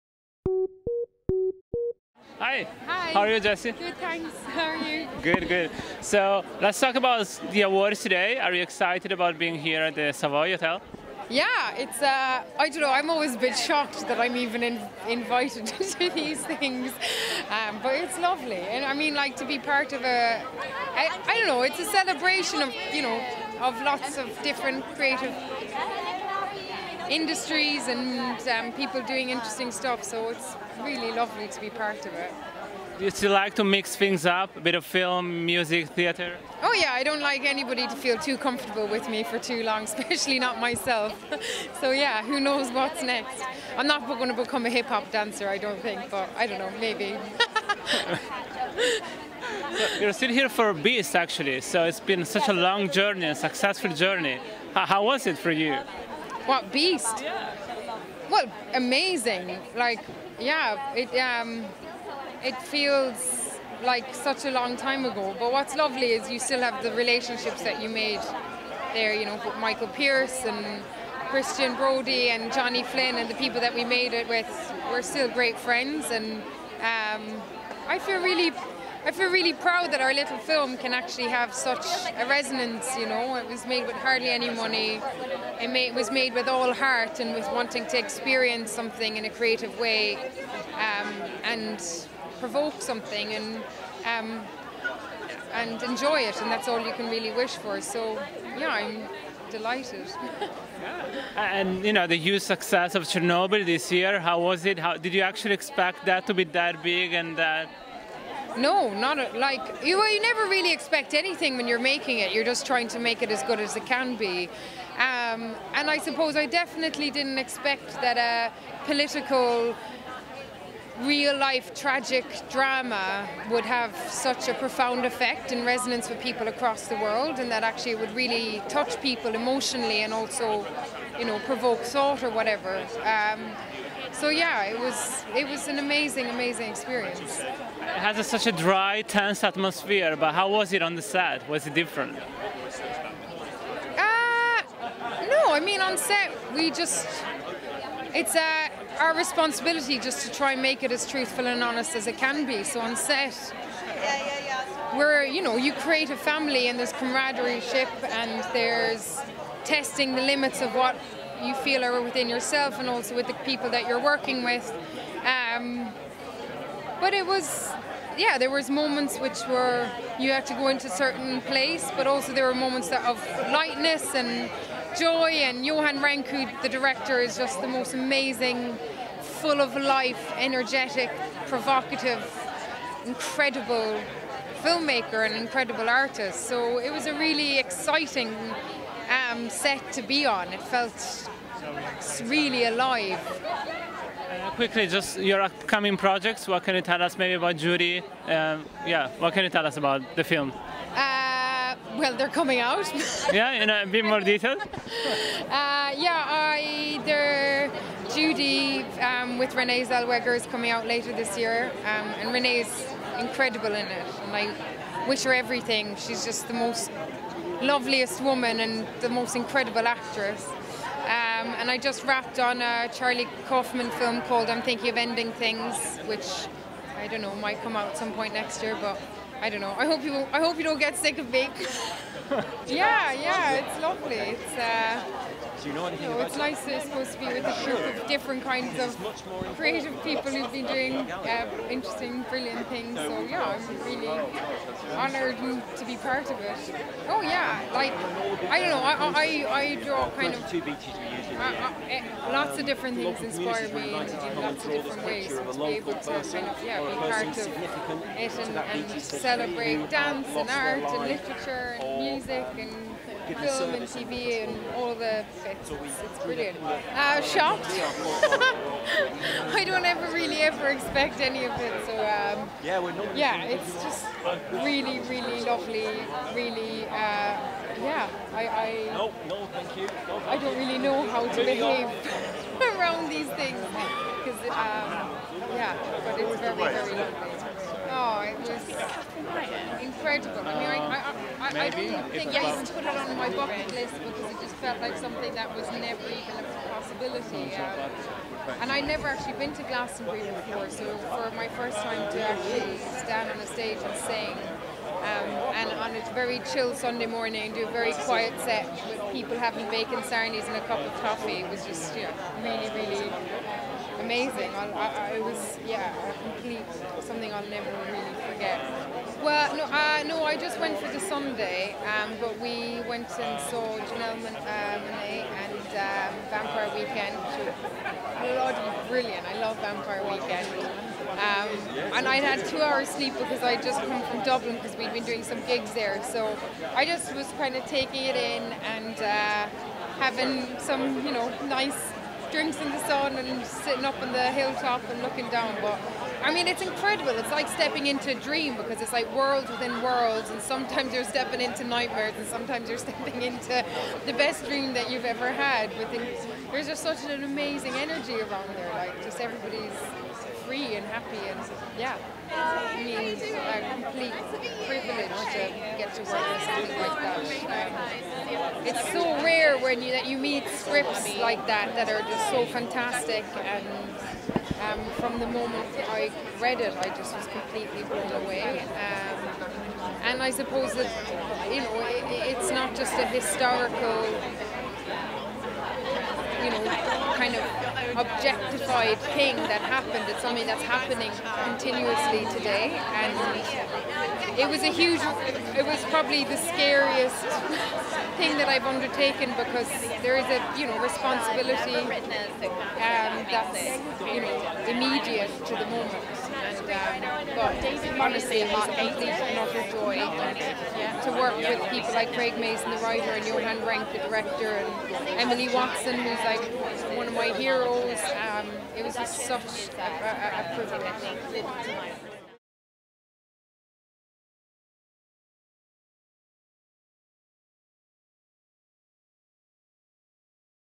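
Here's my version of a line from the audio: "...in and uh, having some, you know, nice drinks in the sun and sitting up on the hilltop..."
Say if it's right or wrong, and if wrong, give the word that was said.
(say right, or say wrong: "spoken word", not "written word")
right.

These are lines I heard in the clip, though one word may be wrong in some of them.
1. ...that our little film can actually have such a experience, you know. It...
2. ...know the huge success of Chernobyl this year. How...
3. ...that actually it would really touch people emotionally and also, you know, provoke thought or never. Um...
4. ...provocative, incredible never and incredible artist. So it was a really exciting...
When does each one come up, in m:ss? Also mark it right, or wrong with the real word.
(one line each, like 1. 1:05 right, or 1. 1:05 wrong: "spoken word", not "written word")
1. 1:19 wrong: "resonance", not "experience"
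2. 1:41 right
3. 2:07 wrong: "whatever", not "never"
4. 3:01 wrong: "filmmaker", not "never".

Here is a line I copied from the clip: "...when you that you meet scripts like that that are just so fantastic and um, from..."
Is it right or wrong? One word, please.
right.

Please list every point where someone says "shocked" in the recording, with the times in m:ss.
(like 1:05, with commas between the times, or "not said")
0:13, 4:27.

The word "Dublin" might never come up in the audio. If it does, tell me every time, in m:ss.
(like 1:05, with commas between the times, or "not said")
5:34.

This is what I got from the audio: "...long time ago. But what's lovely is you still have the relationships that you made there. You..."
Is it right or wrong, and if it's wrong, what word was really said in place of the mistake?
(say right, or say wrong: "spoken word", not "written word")
right.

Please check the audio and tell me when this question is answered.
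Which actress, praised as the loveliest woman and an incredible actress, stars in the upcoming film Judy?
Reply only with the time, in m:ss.
3:29.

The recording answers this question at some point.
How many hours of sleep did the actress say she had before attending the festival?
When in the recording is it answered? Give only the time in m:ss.
5:32.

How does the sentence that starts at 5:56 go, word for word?
there's just such an amazing energy around there.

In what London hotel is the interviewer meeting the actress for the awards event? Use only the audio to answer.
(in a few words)
Savoy Hotel.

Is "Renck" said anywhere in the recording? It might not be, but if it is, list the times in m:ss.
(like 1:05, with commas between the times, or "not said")
2:55, 6:53.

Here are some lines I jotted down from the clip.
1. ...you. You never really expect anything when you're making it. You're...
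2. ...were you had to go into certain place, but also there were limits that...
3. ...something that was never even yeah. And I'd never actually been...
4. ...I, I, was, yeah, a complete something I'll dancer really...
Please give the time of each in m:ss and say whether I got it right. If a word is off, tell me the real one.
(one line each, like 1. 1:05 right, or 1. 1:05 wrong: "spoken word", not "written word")
1. 1:49 right
2. 2:49 wrong: "moments", not "limits"
3. 4:54 right
4. 5:14 wrong: "never", not "dancer".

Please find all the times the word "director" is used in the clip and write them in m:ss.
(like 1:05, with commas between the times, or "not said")
2:56, 6:54.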